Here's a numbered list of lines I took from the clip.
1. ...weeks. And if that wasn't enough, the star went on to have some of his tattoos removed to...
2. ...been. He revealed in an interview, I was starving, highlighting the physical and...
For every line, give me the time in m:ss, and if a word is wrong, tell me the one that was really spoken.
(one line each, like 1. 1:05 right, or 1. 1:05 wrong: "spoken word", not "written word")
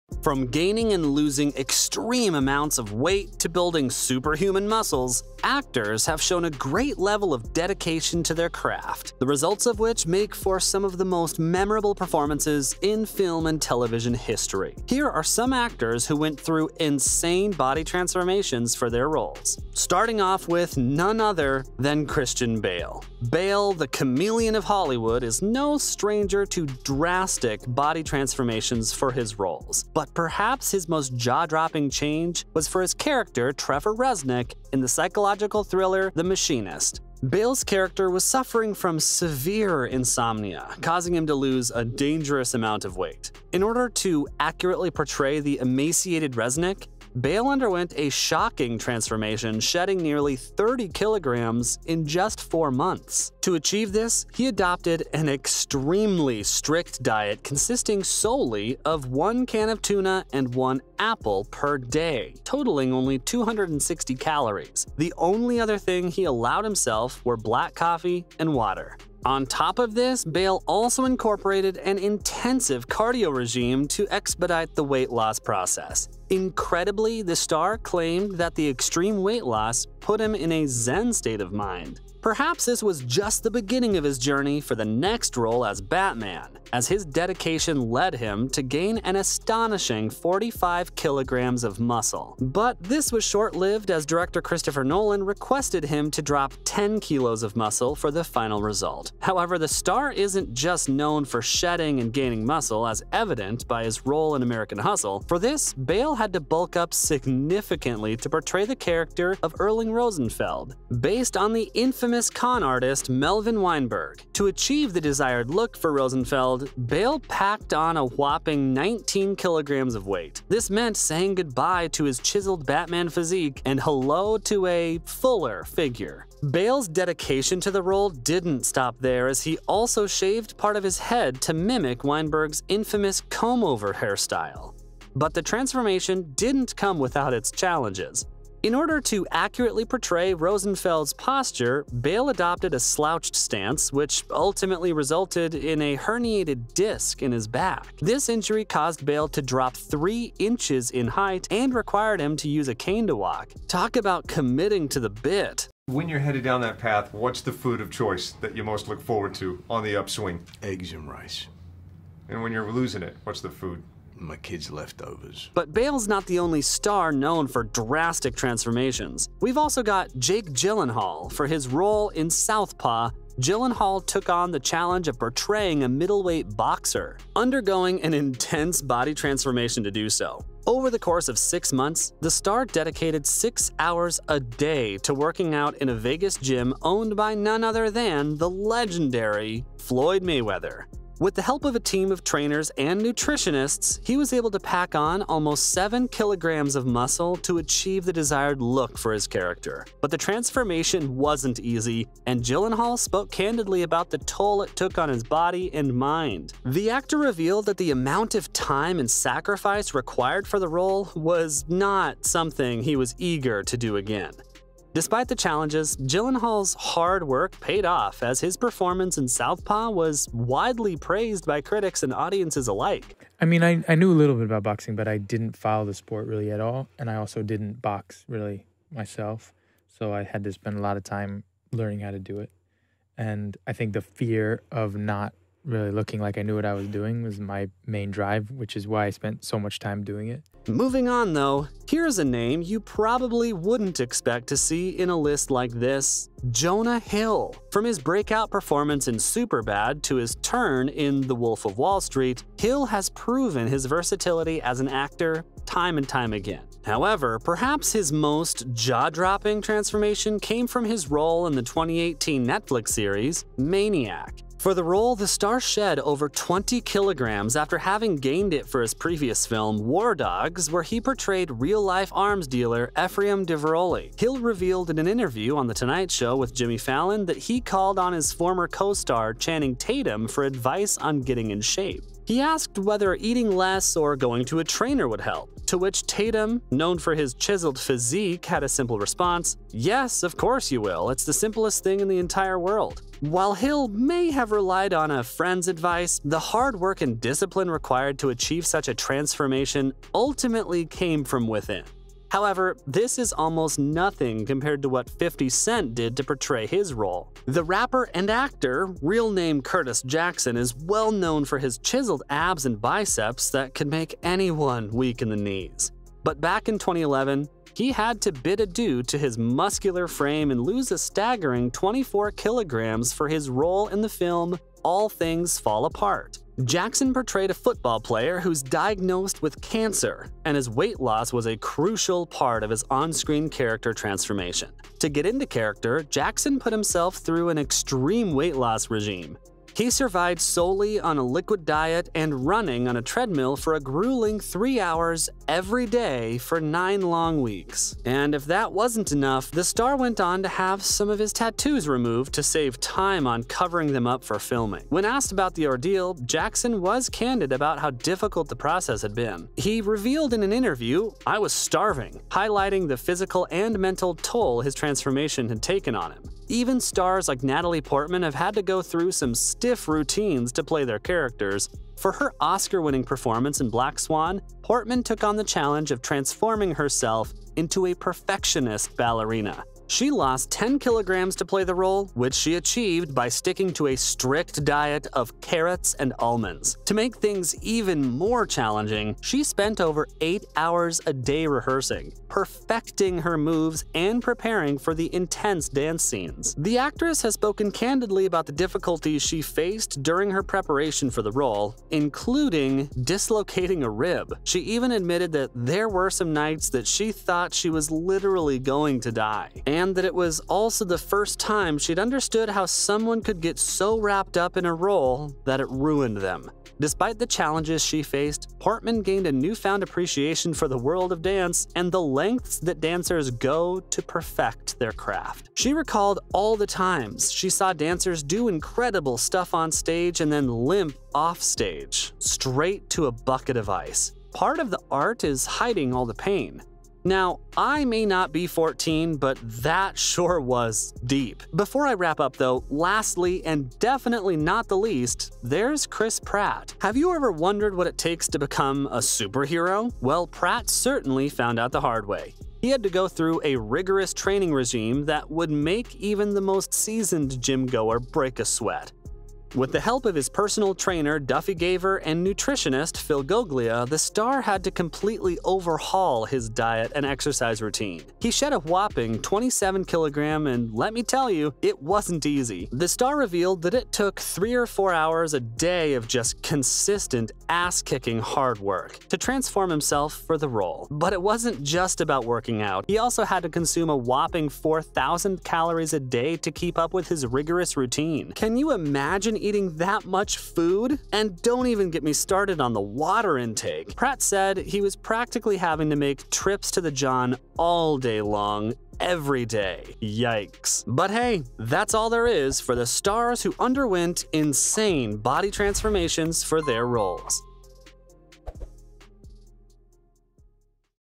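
1. 5:47 right
2. 5:59 right.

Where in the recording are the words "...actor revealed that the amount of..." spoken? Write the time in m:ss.
3:26.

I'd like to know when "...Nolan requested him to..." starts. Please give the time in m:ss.
1:34.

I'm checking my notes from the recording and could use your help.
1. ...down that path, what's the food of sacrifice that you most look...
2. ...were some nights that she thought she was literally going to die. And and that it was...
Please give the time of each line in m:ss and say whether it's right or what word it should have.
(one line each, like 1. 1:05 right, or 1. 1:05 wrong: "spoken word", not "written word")
1. 2:36 wrong: "choice", not "sacrifice"
2. 6:45 right.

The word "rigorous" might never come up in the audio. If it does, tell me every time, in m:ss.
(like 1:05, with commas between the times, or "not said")
7:33, 8:07.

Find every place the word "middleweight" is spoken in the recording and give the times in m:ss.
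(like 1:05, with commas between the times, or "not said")
2:55.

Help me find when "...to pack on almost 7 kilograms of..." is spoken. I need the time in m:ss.
3:14.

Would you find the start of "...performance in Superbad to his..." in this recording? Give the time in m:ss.
4:08.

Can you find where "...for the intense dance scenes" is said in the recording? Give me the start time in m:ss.
6:34.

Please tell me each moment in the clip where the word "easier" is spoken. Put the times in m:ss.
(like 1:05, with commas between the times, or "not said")
not said.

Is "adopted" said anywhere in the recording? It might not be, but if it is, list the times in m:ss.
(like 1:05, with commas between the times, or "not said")
0:54, 2:22.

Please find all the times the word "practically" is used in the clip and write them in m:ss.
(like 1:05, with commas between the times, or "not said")
8:14.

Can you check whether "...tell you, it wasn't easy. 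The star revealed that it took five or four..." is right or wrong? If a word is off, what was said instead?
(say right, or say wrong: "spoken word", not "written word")
wrong: "three", not "five".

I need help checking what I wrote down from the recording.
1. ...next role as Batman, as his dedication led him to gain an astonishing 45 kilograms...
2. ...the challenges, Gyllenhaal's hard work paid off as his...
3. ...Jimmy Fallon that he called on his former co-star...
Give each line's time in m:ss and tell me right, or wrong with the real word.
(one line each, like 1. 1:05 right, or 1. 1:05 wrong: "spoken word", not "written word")
1. 1:24 right
2. 3:35 right
3. 4:36 right.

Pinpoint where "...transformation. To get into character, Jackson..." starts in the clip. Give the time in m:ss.
5:33.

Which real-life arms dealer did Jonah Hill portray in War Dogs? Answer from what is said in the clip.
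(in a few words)
Ephraim Diveroli.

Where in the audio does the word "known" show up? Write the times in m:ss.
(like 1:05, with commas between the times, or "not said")
1:40, 2:47, 4:46, 5:11.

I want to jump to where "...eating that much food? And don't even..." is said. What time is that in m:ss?
8:09.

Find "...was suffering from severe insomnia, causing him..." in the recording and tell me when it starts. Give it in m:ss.
0:38.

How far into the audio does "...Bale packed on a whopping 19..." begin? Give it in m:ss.
1:56.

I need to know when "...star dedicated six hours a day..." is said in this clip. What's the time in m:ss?
3:02.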